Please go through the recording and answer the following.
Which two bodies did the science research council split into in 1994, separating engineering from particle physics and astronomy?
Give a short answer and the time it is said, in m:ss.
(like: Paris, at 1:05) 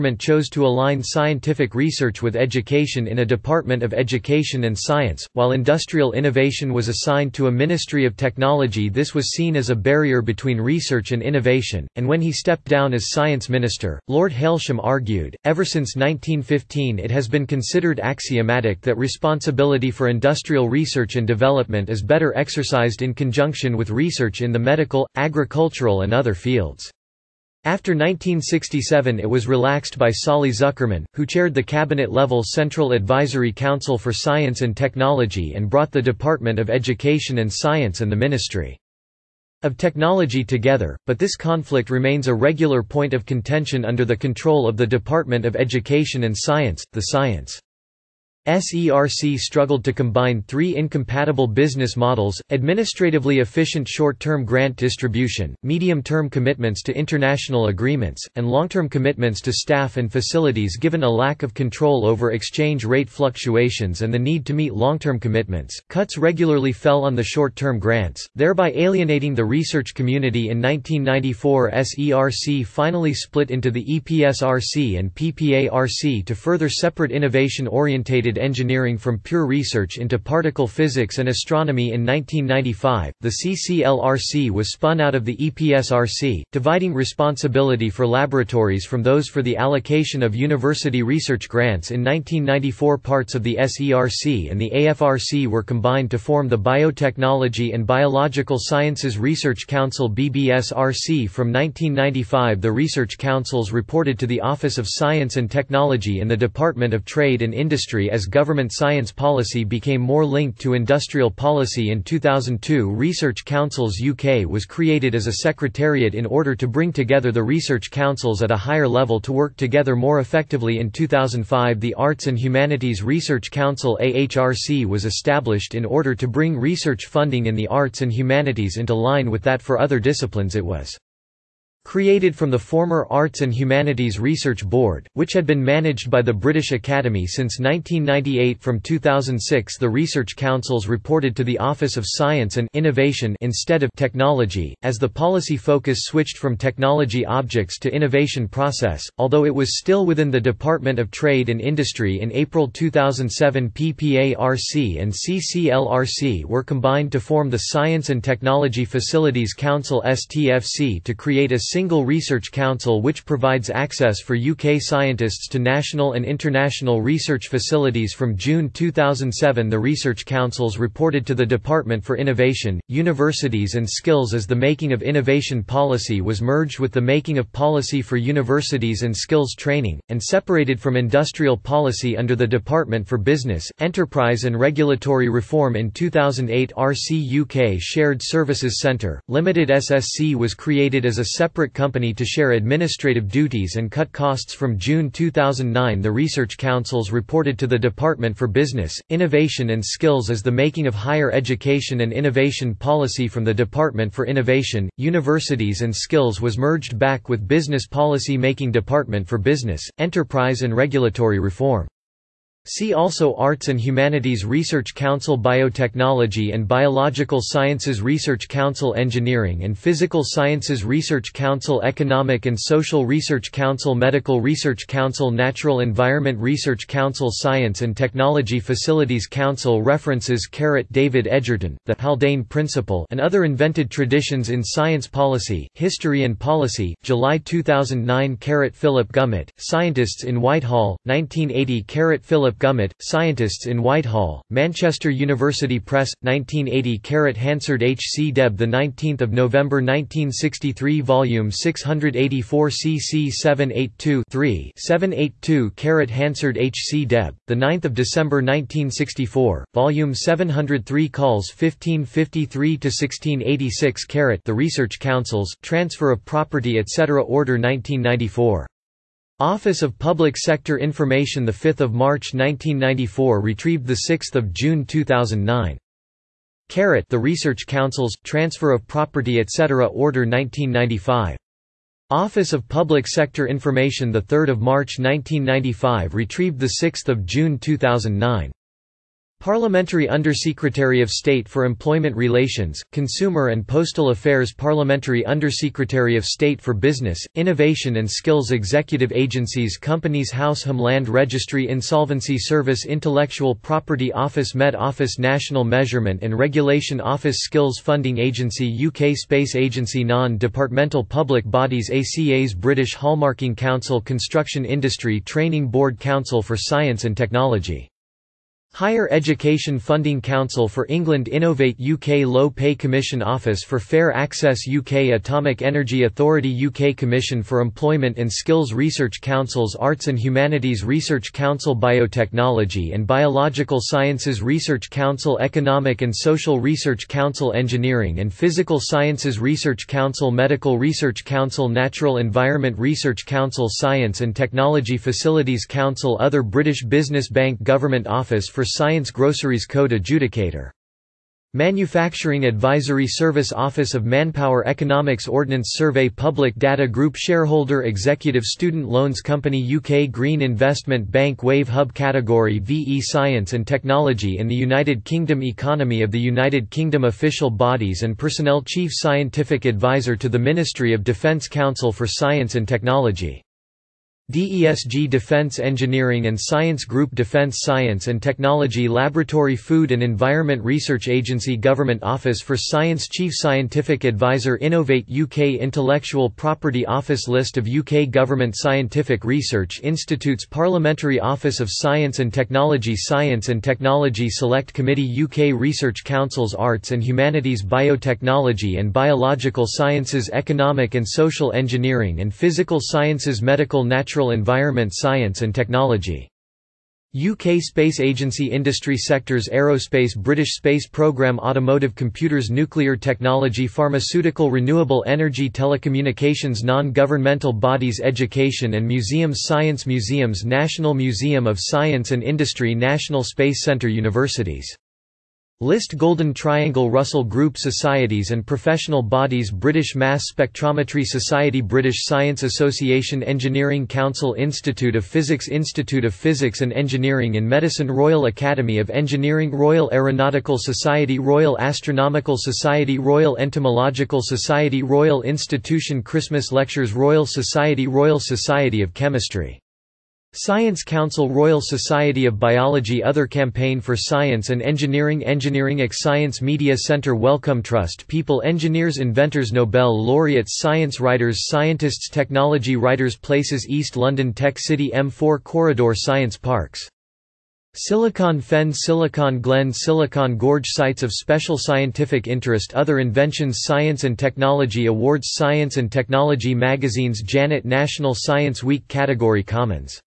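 EPSRC and PPARC, at 1:13.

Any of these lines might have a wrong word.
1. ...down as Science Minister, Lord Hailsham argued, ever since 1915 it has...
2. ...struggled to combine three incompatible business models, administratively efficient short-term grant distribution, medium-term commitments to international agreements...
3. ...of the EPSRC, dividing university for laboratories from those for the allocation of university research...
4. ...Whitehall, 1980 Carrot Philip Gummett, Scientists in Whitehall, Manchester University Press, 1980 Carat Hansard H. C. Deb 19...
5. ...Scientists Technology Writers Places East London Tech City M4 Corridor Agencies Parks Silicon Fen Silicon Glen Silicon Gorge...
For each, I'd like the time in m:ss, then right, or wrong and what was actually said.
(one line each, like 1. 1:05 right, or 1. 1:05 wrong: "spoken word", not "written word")
1. 0:12 right
2. 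0:49 right
3. 1:25 wrong: "responsibility", not "university"
4. 4:00 right
5. 7:41 wrong: "Science", not "Agencies".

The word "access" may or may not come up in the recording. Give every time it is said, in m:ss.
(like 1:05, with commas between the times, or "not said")
2:43, 5:24.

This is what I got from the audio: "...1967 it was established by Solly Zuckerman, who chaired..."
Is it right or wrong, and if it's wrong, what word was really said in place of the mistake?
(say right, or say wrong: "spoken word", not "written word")
wrong: "relaxed", not "established".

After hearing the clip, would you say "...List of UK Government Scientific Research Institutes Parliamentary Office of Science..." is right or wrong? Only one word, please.
right.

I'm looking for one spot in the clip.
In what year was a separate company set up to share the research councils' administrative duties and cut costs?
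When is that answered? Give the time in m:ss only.
3:05.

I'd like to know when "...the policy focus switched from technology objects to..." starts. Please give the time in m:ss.
2:24.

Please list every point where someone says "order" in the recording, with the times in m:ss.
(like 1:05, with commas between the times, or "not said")
1:56, 2:05, 4:27, 4:39.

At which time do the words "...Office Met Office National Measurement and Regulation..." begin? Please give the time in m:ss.
5:04.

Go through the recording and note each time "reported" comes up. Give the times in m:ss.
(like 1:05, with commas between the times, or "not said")
1:43, 2:20, 2:50, 3:17.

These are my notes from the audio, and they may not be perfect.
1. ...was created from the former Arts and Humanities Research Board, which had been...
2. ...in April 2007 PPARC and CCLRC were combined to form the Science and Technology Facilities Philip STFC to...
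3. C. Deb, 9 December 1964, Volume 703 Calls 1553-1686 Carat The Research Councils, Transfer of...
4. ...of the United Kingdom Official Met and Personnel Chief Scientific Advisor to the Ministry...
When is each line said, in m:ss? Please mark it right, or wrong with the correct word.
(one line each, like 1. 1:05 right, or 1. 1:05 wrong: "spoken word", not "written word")
1. 2:10 right
2. 2:32 wrong: "Council", not "Philip"
3. 4:16 right
4. 6:06 wrong: "Bodies", not "Met".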